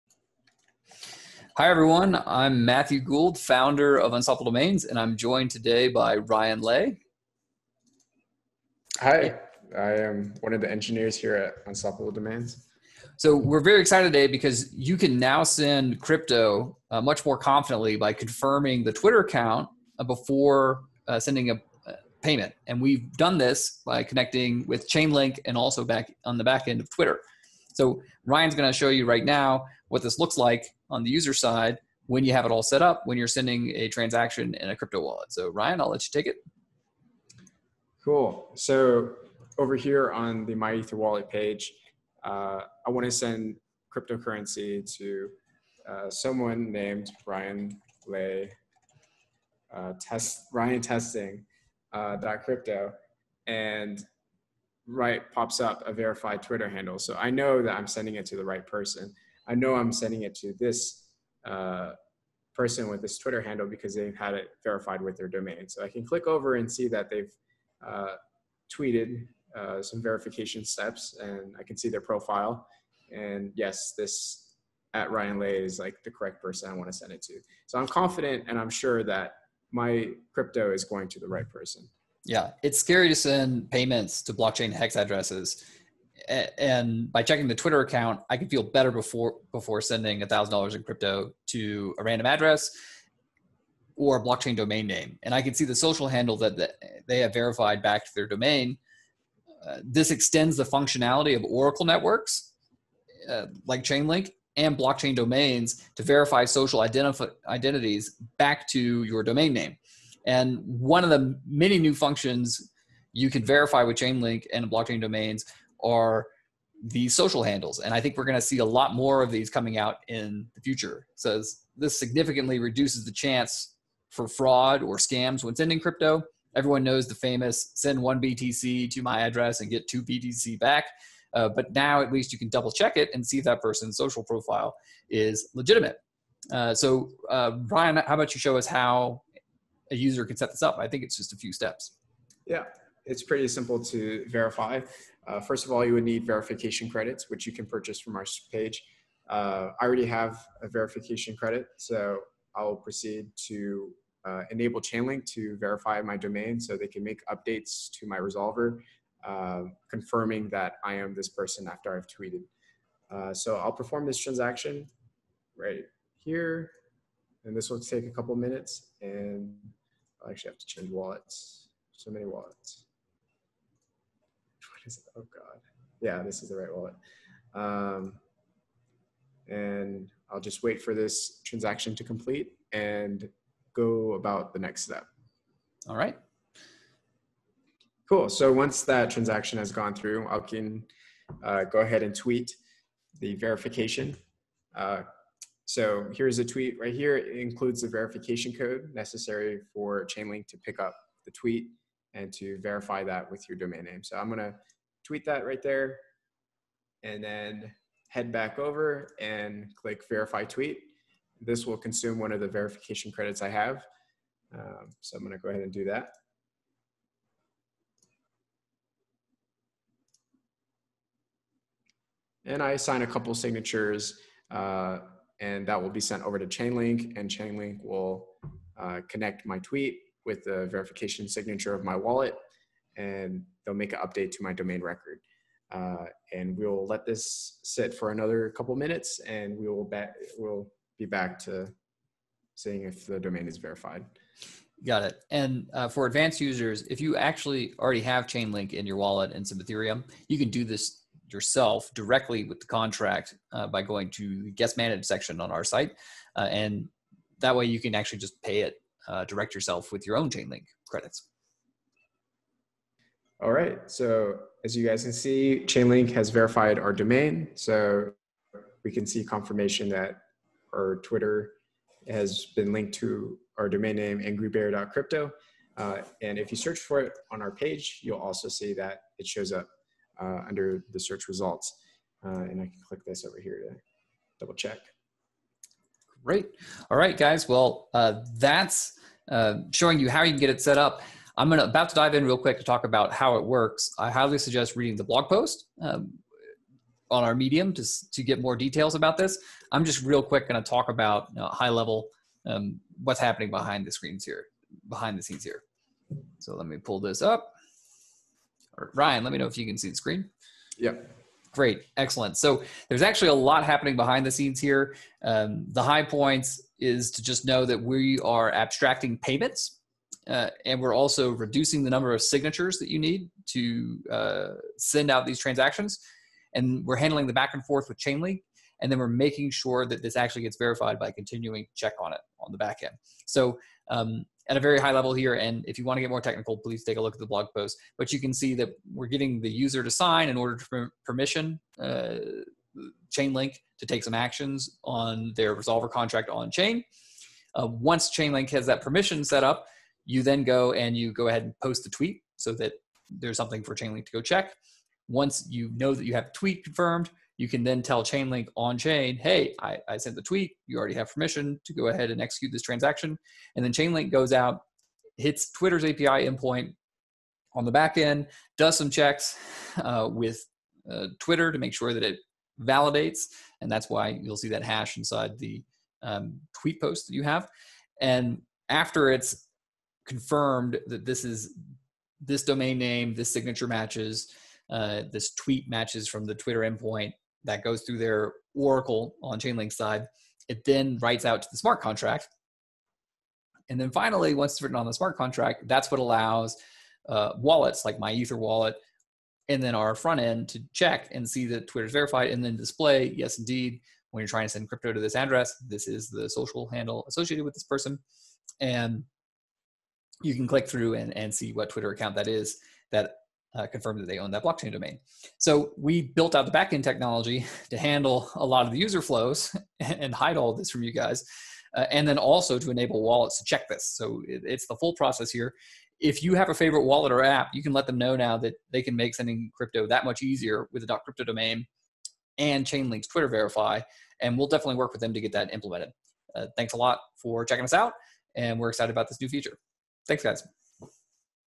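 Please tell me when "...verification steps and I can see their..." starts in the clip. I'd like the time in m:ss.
1:10.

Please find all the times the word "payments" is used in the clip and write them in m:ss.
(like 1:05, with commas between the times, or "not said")
0:22, 1:23, 5:19.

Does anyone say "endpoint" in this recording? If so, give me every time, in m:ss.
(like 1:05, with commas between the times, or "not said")
6:06, 6:26.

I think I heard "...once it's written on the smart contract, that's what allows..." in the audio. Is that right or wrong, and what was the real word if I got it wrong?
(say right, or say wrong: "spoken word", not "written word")
right.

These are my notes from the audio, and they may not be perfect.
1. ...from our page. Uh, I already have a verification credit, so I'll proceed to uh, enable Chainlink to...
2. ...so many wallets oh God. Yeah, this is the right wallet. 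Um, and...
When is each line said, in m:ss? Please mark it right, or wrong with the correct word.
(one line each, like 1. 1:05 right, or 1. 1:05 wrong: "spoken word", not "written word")
1. 2:27 right
2. 2:51 right.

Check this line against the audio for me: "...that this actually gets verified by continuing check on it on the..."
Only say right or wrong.
right.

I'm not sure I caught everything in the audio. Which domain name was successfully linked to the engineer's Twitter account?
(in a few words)
angrybear.crypto.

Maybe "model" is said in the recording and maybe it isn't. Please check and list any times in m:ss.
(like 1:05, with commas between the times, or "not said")
not said.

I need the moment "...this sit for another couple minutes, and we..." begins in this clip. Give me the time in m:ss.
3:57.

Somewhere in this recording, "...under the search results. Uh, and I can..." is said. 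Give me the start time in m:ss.
4:40.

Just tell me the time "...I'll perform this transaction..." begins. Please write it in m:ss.
2:43.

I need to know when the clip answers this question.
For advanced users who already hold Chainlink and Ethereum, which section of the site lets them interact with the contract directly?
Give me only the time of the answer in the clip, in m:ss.
4:14.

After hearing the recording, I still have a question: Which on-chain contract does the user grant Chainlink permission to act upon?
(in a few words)
Resolver contract.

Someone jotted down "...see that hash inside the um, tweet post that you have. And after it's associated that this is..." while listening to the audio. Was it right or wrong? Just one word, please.
wrong.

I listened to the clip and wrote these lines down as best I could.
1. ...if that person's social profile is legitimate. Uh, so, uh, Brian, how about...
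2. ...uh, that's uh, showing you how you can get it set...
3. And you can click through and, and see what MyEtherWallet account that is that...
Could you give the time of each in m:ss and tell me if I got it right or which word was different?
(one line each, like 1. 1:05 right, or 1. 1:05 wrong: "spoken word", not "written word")
1. 2:13 right
2. 4:47 right
3. 6:48 wrong: "Twitter", not "MyEtherWallet".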